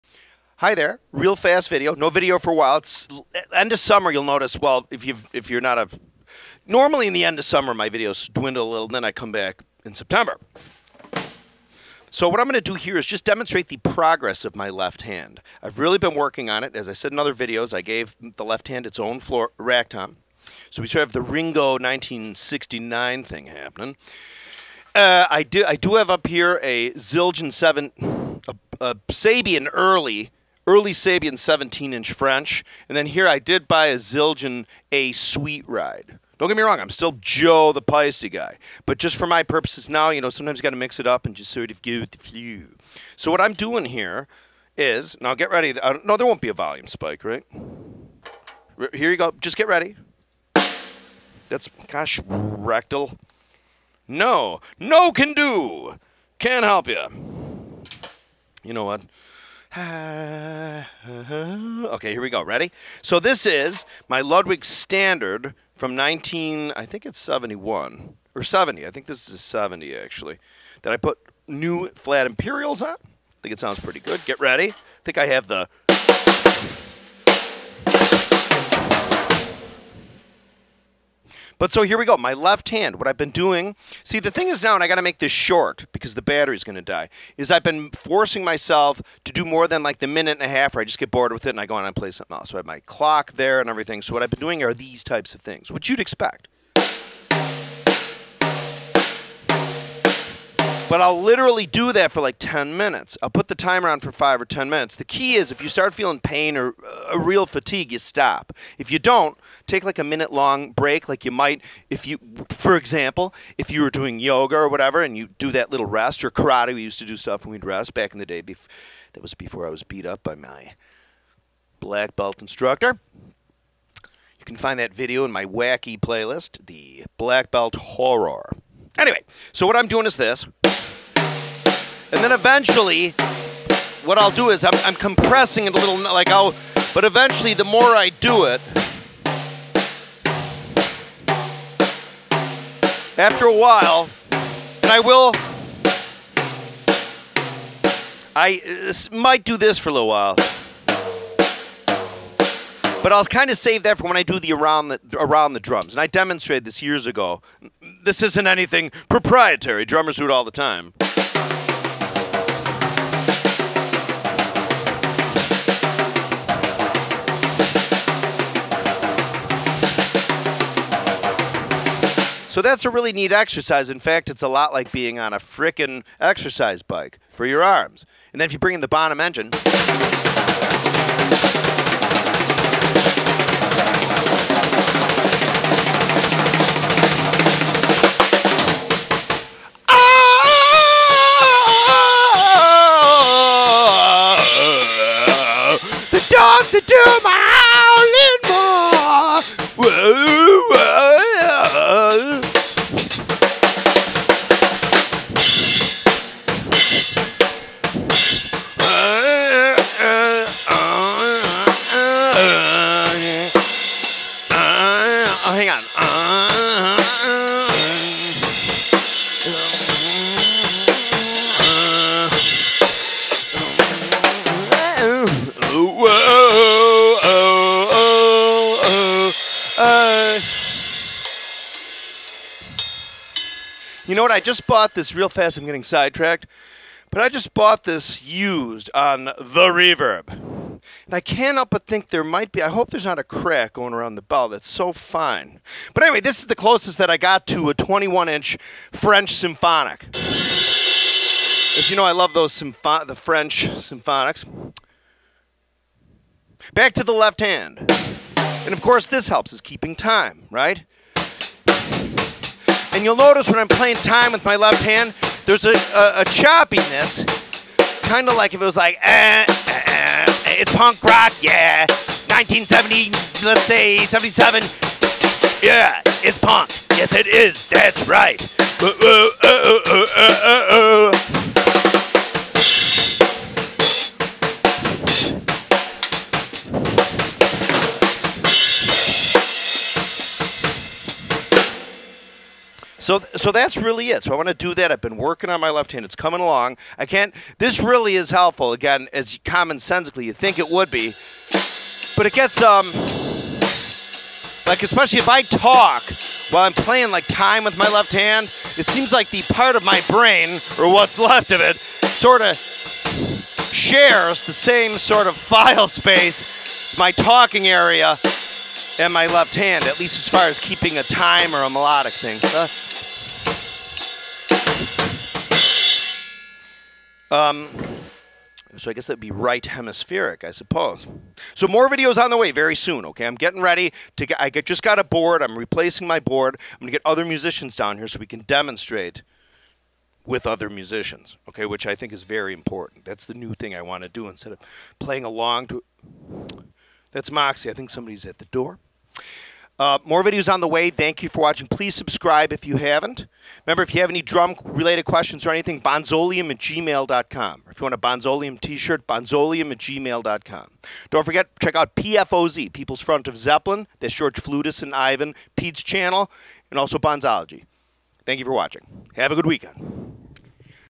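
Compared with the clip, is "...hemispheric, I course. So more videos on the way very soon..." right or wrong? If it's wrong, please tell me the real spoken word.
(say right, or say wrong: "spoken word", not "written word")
wrong: "suppose", not "course".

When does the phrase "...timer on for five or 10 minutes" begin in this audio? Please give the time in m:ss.
1:43.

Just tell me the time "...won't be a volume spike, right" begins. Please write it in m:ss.
0:46.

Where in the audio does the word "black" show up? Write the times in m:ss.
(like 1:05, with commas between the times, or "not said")
2:01, 2:07.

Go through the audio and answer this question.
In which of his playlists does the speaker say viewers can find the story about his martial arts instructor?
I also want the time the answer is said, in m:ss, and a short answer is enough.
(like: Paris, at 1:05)
wacky playlist, at 2:05.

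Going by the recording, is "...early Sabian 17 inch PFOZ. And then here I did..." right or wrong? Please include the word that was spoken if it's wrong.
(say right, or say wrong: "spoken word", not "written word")
wrong: "French", not "PFOZ".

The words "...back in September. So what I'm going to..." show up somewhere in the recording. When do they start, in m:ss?
0:09.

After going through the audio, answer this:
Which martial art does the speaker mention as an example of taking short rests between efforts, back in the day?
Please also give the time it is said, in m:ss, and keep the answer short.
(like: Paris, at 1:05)
karate, at 1:56.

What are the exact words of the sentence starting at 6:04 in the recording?
That's George Flutus and Ivan, Pete's channel, and also Bonzology.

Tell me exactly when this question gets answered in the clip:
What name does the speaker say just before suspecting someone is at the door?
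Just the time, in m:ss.
5:47.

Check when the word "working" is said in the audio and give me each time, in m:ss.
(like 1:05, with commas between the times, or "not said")
0:16, 4:55.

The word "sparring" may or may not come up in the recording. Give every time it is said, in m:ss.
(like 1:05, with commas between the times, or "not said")
not said.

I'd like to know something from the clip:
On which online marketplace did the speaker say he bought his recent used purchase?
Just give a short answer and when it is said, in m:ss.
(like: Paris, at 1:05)
Reverb, at 3:59.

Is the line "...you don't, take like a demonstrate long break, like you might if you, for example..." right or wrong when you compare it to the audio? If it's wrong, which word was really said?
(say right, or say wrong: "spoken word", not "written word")
wrong: "minute", not "demonstrate".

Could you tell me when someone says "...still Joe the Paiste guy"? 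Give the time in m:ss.
0:36.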